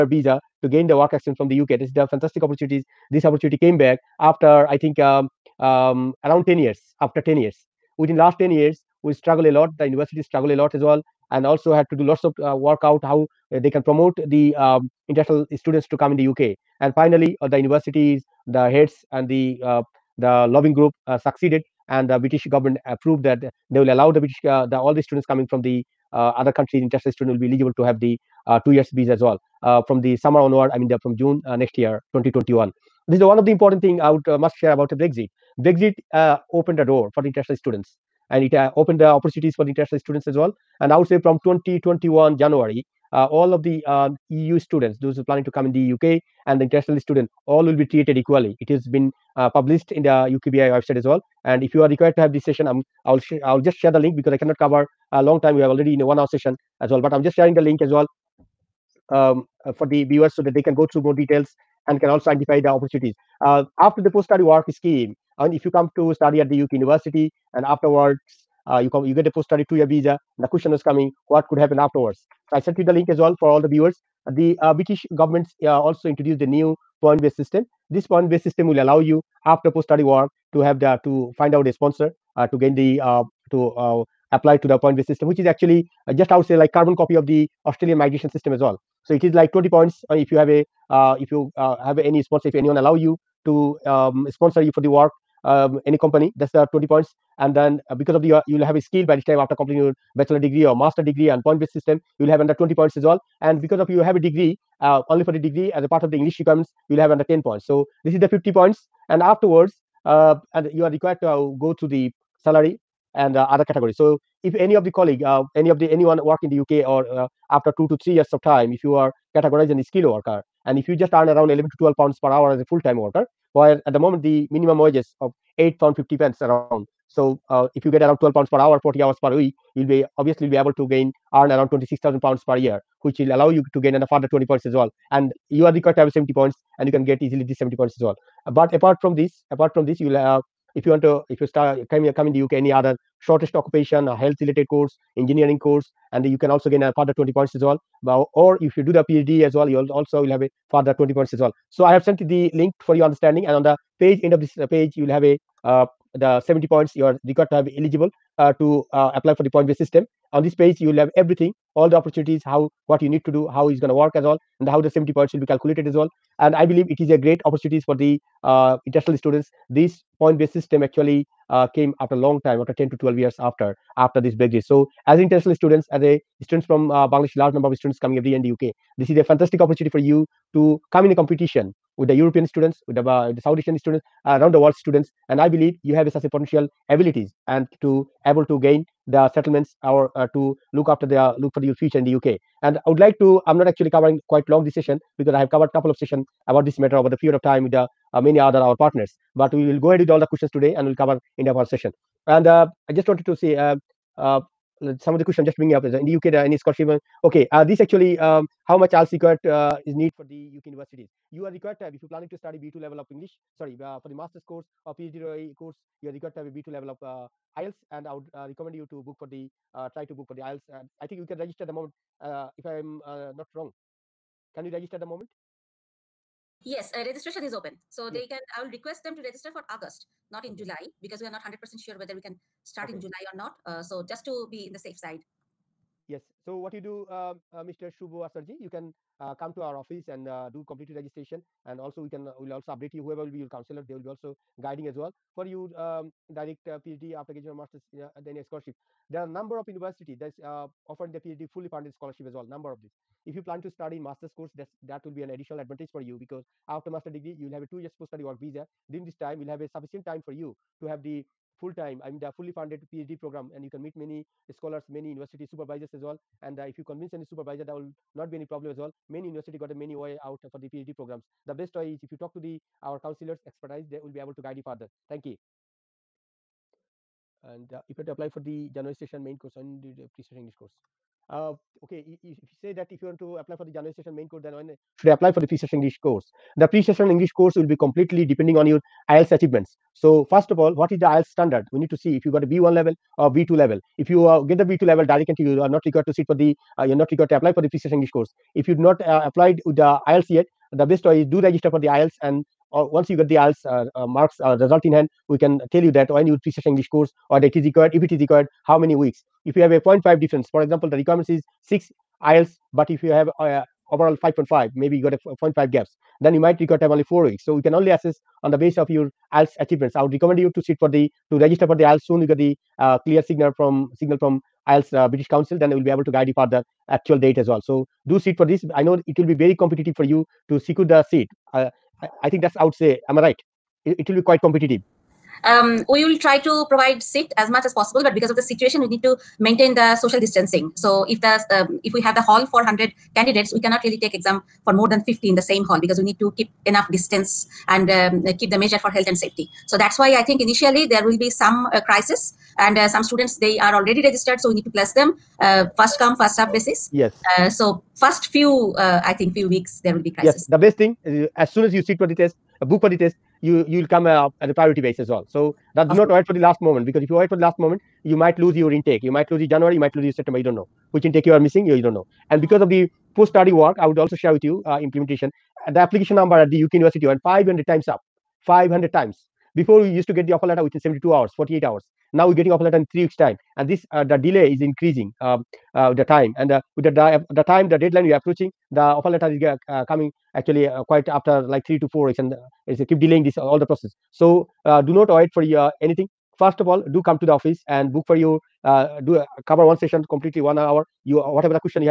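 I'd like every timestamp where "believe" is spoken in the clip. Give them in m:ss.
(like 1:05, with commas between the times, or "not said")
2:46, 3:05.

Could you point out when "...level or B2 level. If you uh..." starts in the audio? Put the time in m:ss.
4:52.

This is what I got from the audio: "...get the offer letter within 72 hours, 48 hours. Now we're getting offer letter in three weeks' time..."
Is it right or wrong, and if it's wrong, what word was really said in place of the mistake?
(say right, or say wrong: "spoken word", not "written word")
right.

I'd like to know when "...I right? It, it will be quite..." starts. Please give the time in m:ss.
5:33.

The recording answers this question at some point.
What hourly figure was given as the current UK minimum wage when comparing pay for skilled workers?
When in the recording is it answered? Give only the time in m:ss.
2:05.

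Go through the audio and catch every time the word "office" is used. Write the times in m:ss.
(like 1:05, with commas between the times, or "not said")
3:59, 6:37.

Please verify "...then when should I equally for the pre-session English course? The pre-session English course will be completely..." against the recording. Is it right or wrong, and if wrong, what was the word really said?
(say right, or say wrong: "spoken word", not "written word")
wrong: "apply", not "equally".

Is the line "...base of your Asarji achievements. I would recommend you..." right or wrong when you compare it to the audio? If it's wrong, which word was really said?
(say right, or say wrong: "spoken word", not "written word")
wrong: "IELTS", not "Asarji".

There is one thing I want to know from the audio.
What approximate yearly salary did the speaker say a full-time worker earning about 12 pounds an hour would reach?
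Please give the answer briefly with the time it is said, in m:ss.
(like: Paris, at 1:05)
26,000 pounds, at 2:11.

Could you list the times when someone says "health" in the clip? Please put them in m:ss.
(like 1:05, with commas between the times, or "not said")
2:24, 5:48.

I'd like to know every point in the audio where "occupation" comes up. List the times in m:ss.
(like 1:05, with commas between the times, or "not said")
2:23.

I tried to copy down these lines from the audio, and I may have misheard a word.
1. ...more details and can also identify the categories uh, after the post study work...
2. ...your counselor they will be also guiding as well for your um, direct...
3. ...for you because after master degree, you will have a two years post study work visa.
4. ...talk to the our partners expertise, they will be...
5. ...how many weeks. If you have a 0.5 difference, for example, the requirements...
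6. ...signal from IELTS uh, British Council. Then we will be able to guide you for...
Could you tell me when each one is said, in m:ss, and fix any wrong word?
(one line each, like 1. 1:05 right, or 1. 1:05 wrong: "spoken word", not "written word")
1. 1:01 wrong: "opportunities", not "categories"
2. 4:03 right
3. 4:15 right
4. 4:32 wrong: "counselors", not "partners"
5. 5:08 right
6. 5:23 right.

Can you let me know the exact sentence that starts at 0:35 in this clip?
Brexit uh, opened the door for the international students, and it uh, opened the opportunities for the international students as well.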